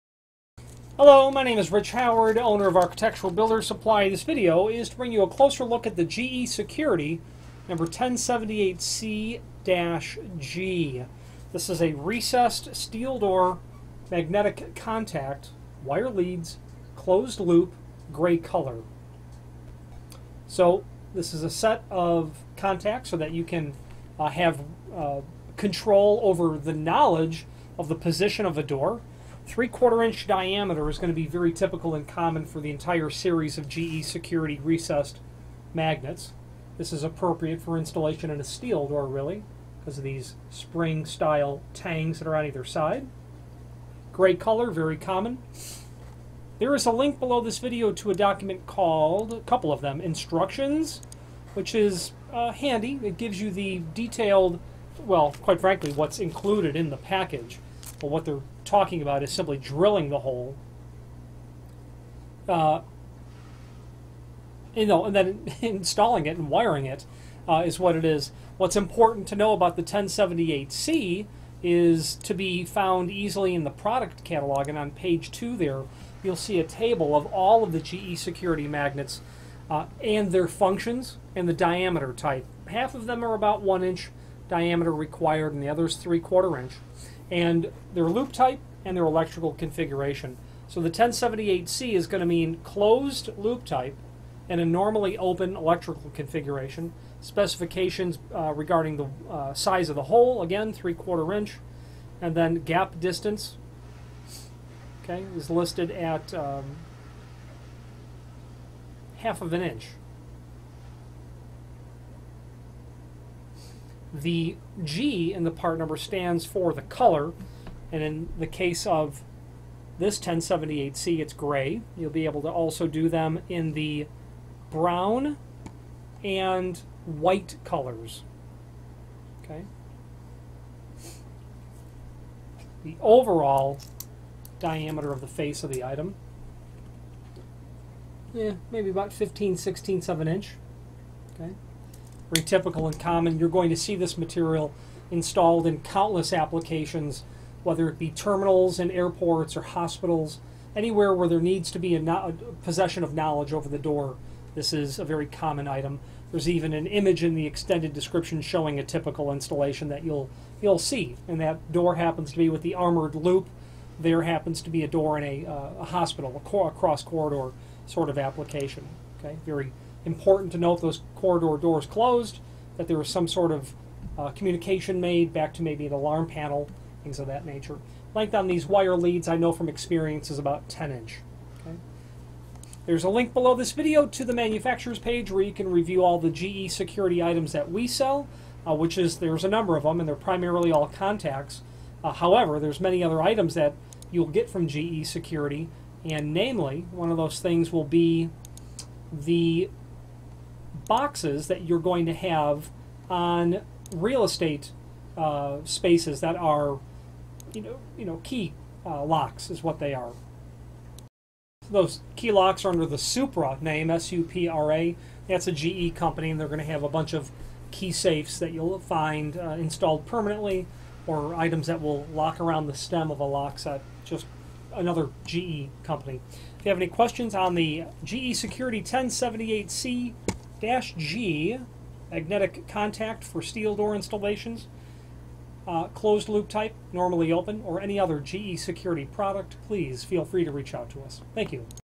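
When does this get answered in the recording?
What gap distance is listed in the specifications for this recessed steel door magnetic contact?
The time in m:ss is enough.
1:49.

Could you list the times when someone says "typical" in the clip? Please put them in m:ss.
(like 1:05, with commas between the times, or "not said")
0:31, 2:22, 2:38.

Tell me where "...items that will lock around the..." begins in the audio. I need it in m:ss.
3:41.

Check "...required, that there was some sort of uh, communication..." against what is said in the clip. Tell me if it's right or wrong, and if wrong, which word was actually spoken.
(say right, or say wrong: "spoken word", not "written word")
wrong: "closed", not "required".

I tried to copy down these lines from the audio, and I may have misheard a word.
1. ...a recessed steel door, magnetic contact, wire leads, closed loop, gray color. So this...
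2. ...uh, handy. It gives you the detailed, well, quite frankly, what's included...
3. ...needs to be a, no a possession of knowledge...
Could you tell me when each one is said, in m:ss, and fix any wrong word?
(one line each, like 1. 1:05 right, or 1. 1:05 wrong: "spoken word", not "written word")
1. 0:11 right
2. 0:52 right
3. 2:31 right.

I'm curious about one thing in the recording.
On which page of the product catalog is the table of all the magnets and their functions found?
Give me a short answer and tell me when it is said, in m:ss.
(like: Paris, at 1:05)
page 2, at 1:14.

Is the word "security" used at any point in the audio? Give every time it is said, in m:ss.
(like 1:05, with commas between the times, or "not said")
0:06, 0:34, 1:18, 3:06, 3:15, 3:48, 3:58.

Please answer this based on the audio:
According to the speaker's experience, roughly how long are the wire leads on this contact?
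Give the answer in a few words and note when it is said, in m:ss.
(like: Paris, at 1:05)
10 inch, at 3:00.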